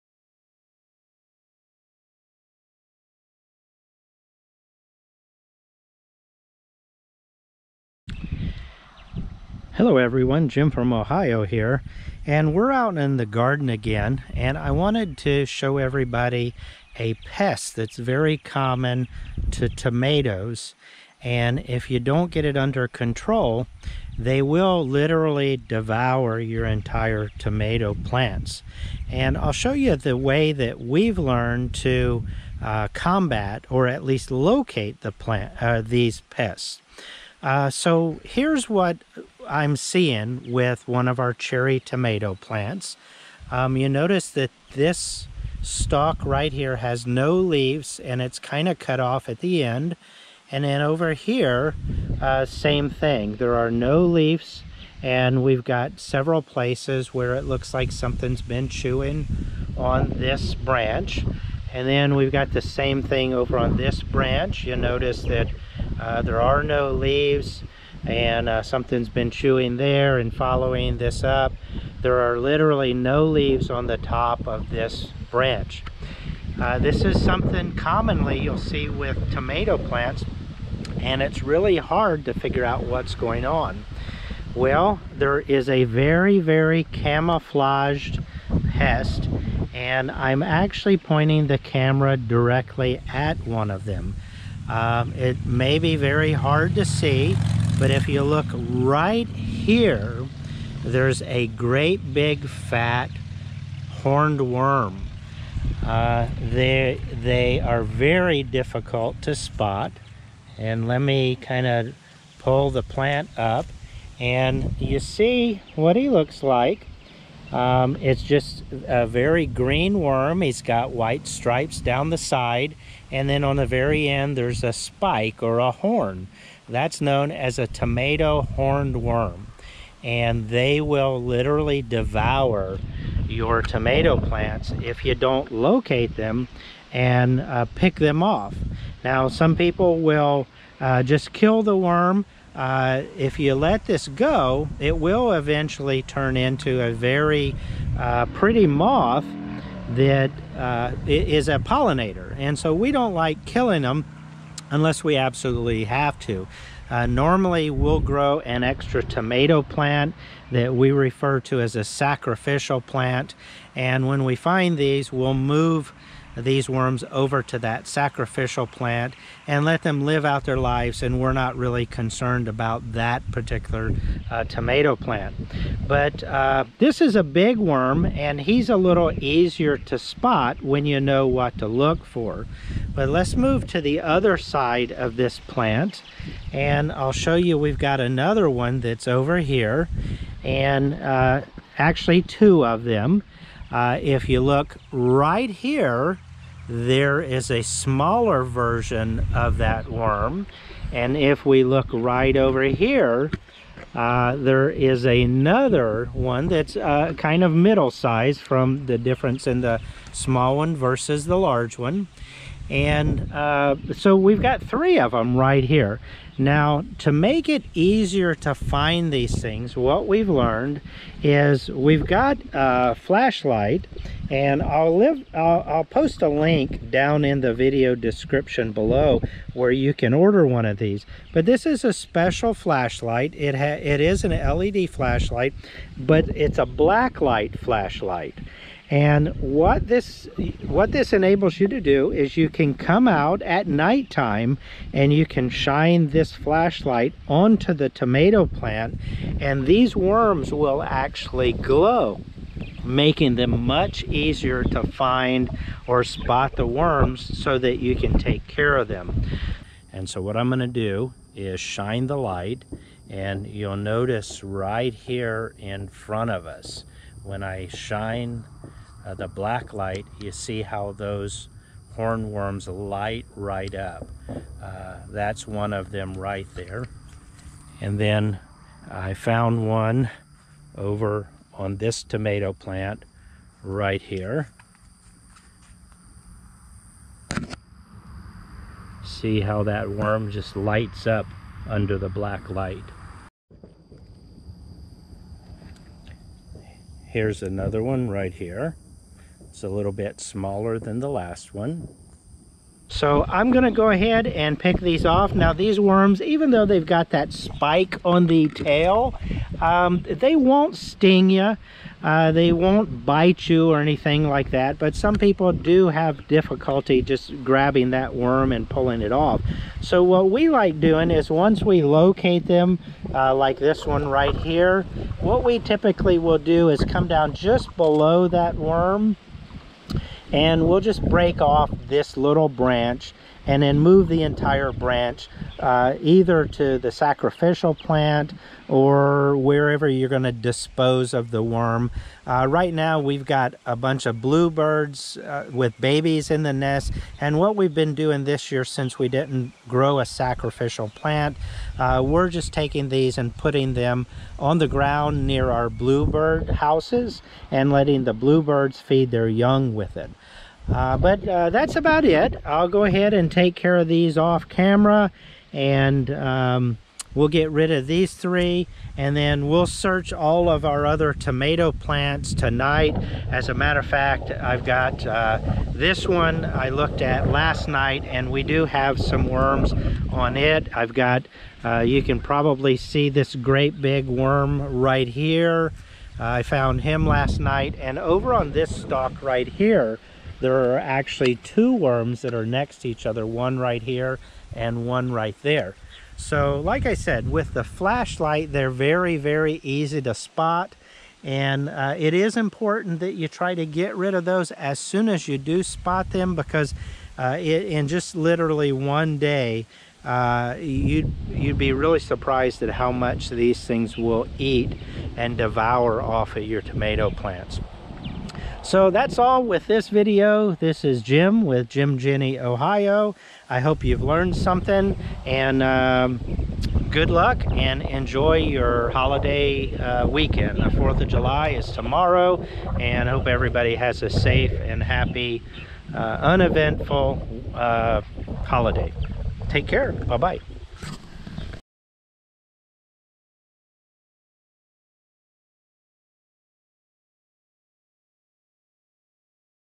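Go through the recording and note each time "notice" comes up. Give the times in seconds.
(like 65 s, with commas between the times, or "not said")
43 s, 64 s, 263 s.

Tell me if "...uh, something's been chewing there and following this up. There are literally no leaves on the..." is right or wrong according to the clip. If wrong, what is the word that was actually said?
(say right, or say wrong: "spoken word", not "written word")
right.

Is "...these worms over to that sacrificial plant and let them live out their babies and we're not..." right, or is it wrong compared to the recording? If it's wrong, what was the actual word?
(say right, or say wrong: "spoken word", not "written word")
wrong: "lives", not "babies".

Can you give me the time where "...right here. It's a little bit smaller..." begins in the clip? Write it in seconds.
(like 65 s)
298 s.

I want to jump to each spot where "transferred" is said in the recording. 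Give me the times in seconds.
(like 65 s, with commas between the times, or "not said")
not said.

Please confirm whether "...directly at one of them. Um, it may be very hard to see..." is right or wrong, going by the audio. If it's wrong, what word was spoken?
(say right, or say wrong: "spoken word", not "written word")
right.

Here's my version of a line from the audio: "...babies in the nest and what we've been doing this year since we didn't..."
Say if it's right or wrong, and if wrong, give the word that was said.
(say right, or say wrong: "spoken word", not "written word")
right.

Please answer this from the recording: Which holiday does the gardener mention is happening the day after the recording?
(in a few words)
4th of July.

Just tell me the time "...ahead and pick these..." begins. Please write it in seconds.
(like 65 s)
303 s.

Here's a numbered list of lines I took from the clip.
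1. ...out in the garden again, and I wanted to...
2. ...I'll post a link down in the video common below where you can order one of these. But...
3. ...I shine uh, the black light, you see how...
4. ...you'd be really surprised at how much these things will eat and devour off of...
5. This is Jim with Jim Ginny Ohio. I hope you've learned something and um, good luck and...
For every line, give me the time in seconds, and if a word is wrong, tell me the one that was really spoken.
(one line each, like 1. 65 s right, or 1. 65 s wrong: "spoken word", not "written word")
1. 12 s right
2. 225 s wrong: "description", not "common"
3. 267 s right
4. 411 s right
5. 420 s right.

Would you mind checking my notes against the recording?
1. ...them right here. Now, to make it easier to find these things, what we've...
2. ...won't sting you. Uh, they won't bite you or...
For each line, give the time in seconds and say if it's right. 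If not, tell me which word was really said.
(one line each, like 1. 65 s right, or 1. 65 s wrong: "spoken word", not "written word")
1. 215 s right
2. 310 s right.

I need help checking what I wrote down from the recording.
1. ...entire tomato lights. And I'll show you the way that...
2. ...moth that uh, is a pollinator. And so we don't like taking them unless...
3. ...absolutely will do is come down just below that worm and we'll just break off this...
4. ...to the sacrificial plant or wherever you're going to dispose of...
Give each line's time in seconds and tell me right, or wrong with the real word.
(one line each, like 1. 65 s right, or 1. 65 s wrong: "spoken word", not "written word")
1. 26 s wrong: "plants", not "lights"
2. 148 s wrong: "killing", not "taking"
3. 325 s wrong: "typically", not "absolutely"
4. 336 s right.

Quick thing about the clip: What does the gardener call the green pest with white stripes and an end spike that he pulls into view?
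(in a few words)
tomato horned worm.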